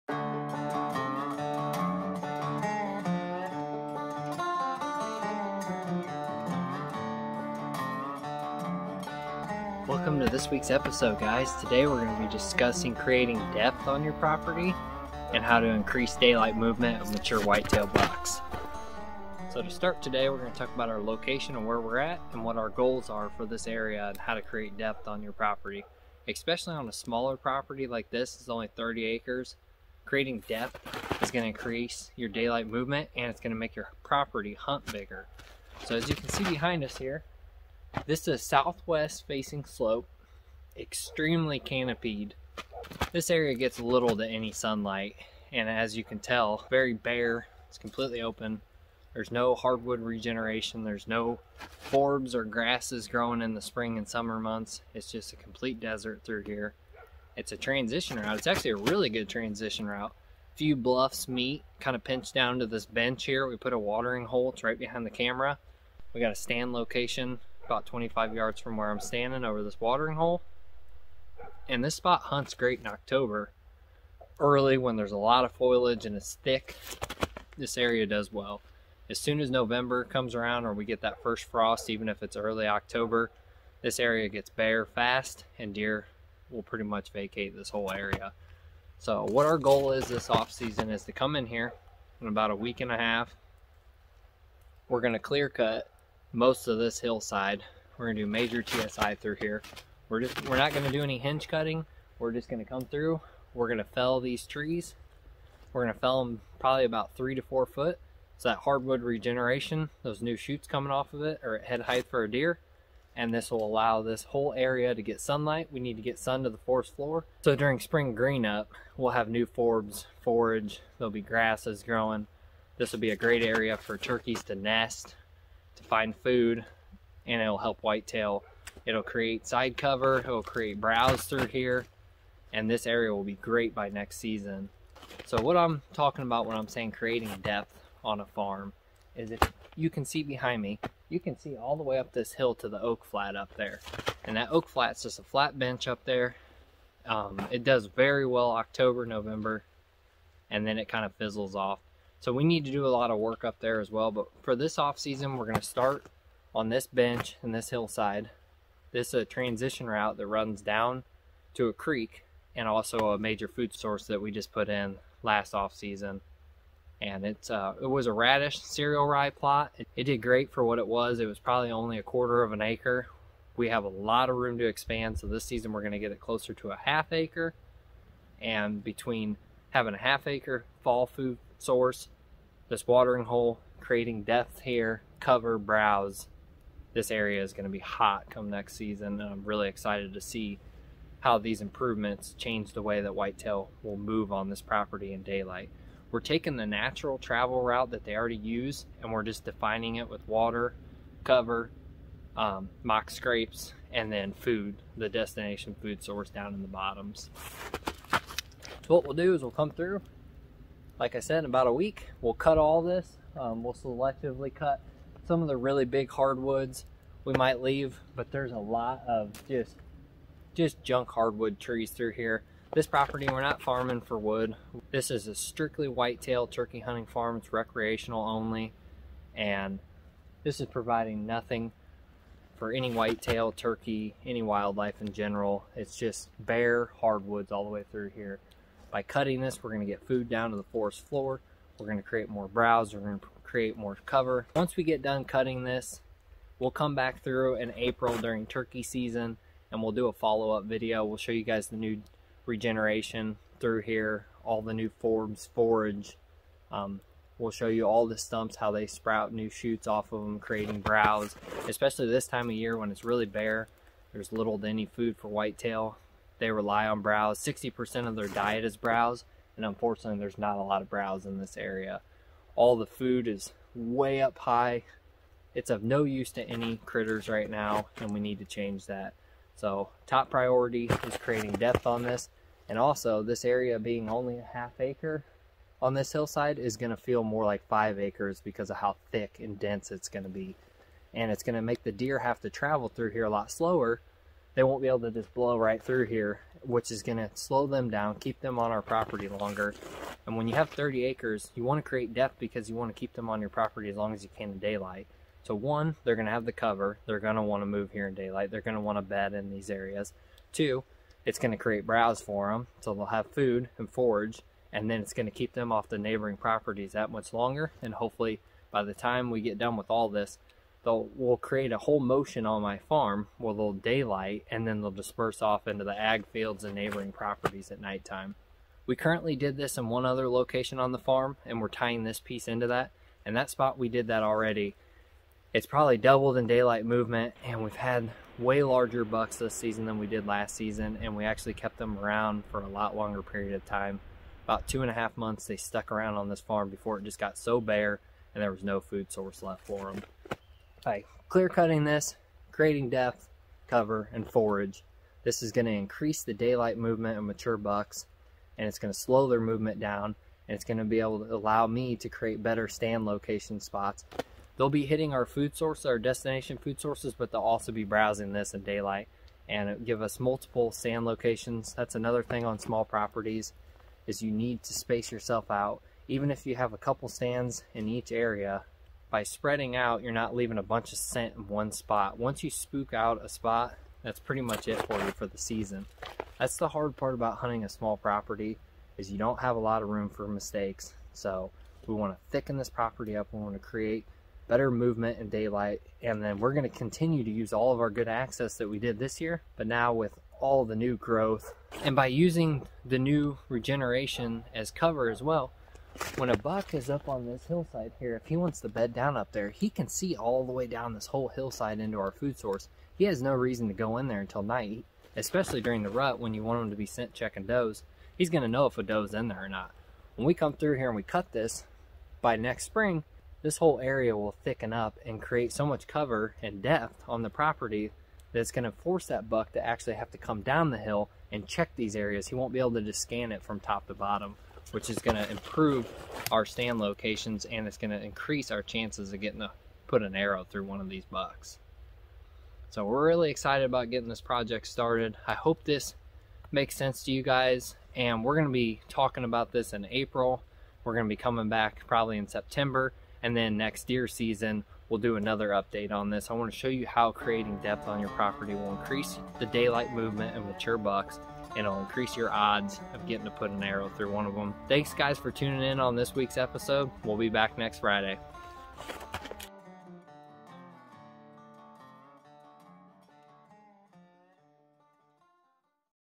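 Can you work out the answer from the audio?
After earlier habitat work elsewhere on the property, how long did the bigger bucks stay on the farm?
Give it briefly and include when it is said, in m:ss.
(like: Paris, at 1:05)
2.5 months, at 5:44.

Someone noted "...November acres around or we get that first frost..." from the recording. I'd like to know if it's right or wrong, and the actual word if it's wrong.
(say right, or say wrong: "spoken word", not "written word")
wrong: "comes", not "acres".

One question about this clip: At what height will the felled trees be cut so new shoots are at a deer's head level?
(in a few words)
3 to 4 feet.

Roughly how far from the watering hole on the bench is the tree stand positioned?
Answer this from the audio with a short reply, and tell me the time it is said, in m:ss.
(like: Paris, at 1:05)
25 yards, at 1:07.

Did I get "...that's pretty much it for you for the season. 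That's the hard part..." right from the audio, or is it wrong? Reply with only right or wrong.
right.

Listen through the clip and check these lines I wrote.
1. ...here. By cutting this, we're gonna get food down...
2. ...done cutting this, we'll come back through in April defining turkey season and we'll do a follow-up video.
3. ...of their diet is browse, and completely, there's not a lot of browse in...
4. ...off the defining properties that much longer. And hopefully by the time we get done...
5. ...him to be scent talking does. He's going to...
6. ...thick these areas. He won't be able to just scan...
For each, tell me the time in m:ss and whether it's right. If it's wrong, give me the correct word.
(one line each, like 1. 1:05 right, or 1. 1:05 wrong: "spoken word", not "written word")
1. 3:58 right
2. 4:05 wrong: "during", not "defining"
3. 4:28 wrong: "unfortunately", not "completely"
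4. 5:15 wrong: "neighboring", not "defining"
5. 6:56 wrong: "checking", not "talking"
6. 7:11 wrong: "check", not "thick".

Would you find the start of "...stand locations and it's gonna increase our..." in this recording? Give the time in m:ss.
7:16.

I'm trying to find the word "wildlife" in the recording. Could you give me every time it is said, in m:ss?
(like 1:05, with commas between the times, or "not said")
3:54.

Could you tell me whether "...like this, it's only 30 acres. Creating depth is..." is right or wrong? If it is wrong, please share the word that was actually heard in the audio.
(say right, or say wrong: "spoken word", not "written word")
right.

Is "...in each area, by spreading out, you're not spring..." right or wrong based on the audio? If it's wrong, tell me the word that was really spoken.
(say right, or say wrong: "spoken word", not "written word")
wrong: "leaving", not "spring".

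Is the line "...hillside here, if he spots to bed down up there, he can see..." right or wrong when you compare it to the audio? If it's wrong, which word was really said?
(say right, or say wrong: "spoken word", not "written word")
wrong: "wants", not "spots".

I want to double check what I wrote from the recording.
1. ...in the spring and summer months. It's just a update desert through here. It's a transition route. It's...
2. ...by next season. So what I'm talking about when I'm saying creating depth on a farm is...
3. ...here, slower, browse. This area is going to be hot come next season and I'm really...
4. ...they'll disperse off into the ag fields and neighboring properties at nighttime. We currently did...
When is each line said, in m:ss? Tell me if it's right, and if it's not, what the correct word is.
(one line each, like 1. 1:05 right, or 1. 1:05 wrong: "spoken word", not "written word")
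1. 0:53 wrong: "complete", not "update"
2. 2:13 right
3. 3:04 wrong: "cover", not "slower"
4. 5:24 right.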